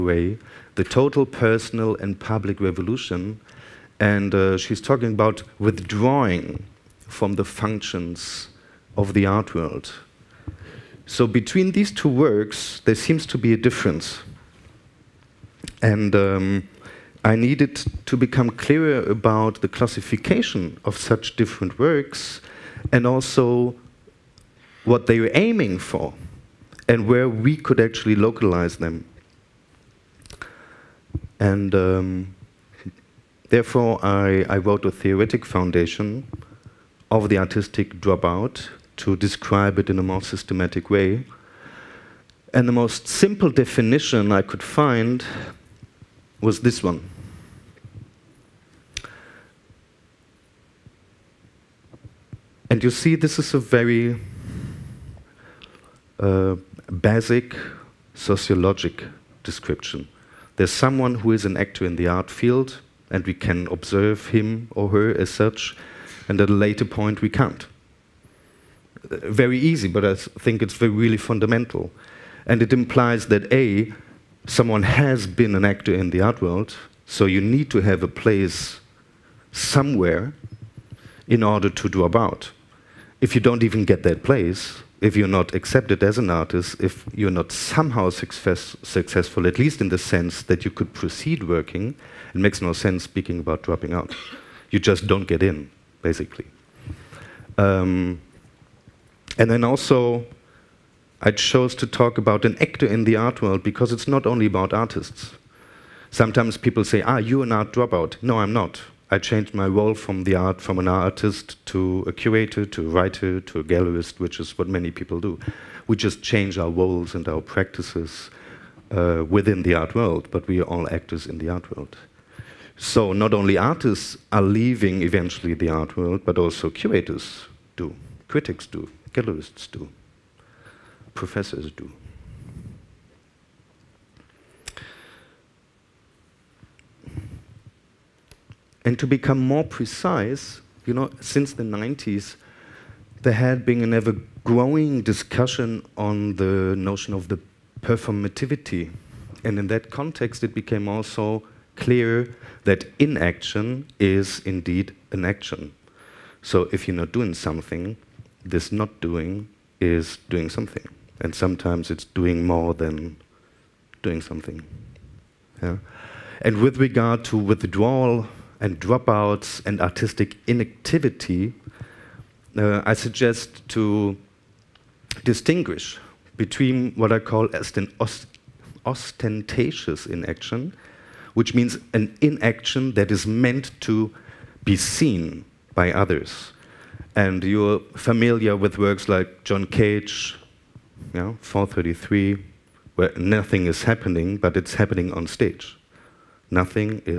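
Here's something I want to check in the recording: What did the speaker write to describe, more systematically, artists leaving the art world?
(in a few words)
A theoretic foundation of the artistic dropout.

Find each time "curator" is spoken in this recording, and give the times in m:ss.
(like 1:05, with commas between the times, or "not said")
1:52, 2:06.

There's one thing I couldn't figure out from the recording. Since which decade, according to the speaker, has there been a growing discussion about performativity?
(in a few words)
The 90s.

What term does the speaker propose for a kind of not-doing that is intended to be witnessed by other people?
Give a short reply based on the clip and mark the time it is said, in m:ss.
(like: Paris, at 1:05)
Ostentatious inaction, at 2:58.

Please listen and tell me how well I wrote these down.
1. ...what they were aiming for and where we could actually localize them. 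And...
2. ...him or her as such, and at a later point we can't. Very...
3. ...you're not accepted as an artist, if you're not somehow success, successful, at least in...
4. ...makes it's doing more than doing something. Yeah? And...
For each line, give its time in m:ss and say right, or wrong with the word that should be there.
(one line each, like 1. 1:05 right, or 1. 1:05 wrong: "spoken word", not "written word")
1. 0:24 right
2. 1:04 right
3. 1:25 right
4. 2:41 wrong: "sometimes", not "makes".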